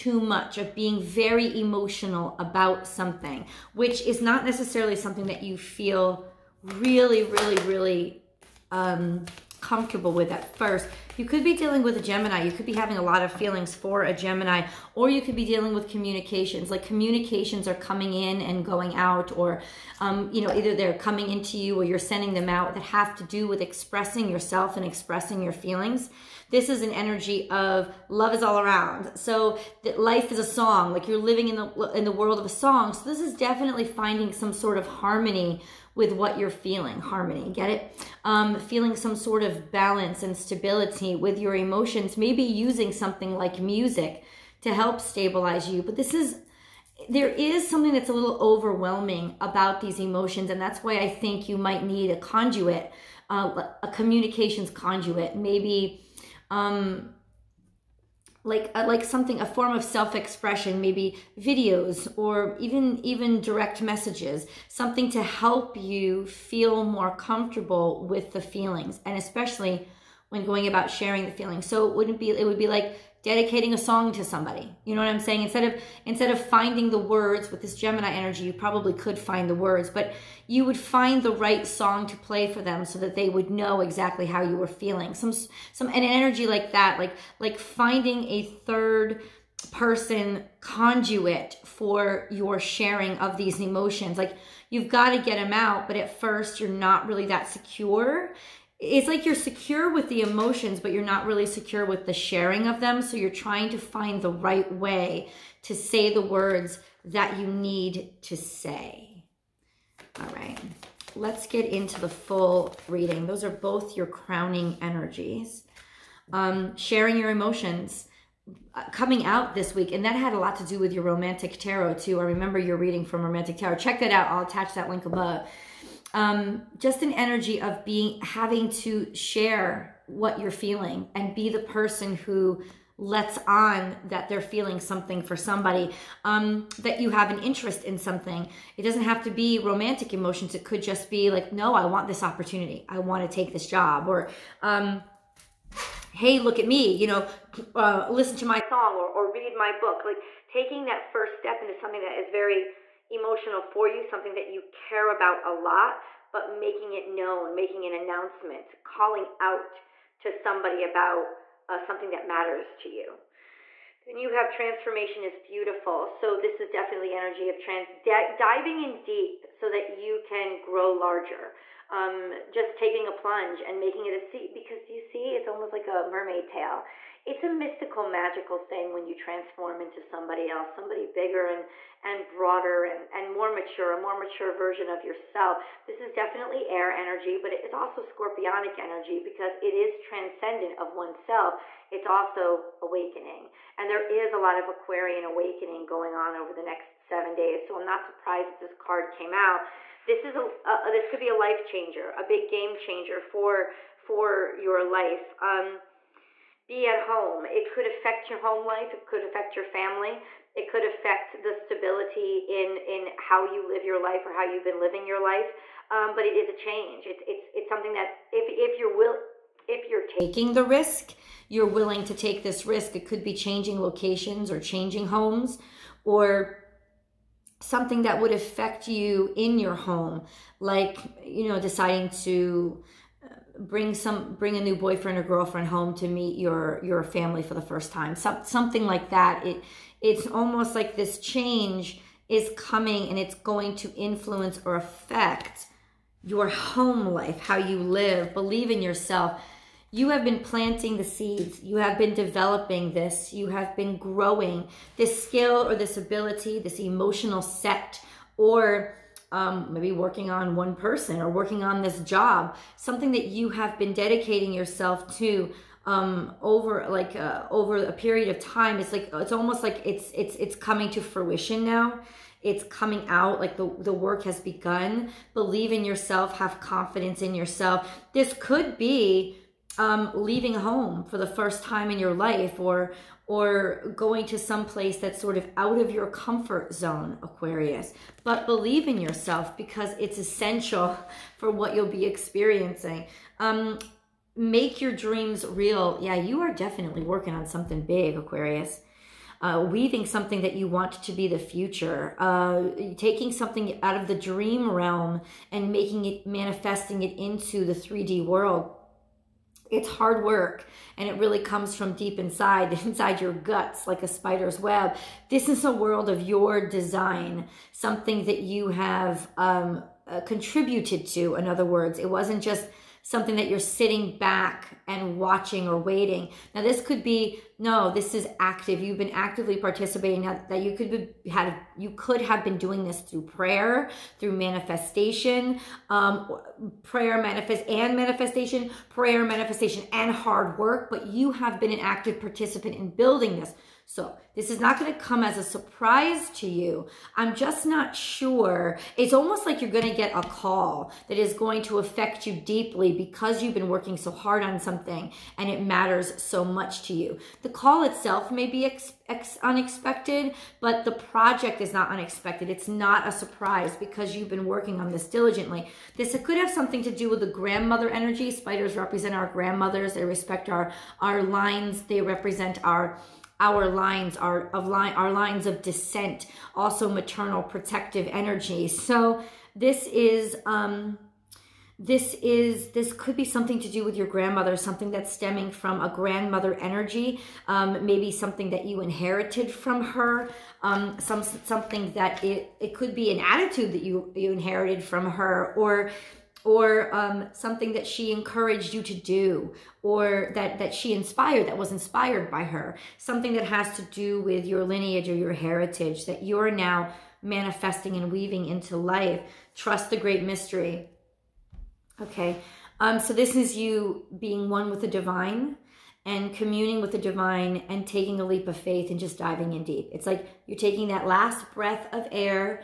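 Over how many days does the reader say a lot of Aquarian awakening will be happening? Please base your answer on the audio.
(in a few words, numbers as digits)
7.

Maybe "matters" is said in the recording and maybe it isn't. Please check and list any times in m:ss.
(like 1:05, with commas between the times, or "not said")
2:42, 5:55.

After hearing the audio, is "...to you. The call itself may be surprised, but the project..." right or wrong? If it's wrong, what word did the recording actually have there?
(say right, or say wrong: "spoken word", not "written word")
wrong: "unexpected", not "surprised".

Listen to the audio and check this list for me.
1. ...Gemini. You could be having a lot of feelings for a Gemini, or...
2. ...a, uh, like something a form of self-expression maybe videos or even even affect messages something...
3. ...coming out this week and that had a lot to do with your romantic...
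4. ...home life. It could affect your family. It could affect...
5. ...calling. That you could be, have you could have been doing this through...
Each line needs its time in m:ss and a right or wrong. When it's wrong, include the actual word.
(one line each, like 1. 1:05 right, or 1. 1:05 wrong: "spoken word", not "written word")
1. 0:12 right
2. 0:58 wrong: "direct", not "affect"
3. 1:58 right
4. 3:28 right
5. 5:29 wrong: "participating", not "calling".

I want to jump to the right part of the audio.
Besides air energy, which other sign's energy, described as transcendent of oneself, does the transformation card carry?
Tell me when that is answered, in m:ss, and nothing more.
3:08.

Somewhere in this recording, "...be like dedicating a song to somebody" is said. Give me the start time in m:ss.
1:12.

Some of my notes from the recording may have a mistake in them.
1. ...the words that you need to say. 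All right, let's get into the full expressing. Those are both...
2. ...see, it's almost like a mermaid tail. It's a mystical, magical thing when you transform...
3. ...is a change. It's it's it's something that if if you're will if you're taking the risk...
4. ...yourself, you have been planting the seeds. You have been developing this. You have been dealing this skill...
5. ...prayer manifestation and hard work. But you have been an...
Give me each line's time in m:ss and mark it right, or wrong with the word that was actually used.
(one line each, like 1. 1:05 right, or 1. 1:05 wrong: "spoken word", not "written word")
1. 1:46 wrong: "reading", not "expressing"
2. 2:54 right
3. 3:36 right
4. 4:08 wrong: "growing", not "dealing"
5. 5:38 right.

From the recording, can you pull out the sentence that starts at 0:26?
This is an energy of love is all around.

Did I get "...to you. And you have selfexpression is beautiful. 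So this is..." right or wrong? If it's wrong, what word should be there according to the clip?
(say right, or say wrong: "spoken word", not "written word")
wrong: "transformation", not "selfexpression".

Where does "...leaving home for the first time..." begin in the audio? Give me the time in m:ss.
4:40.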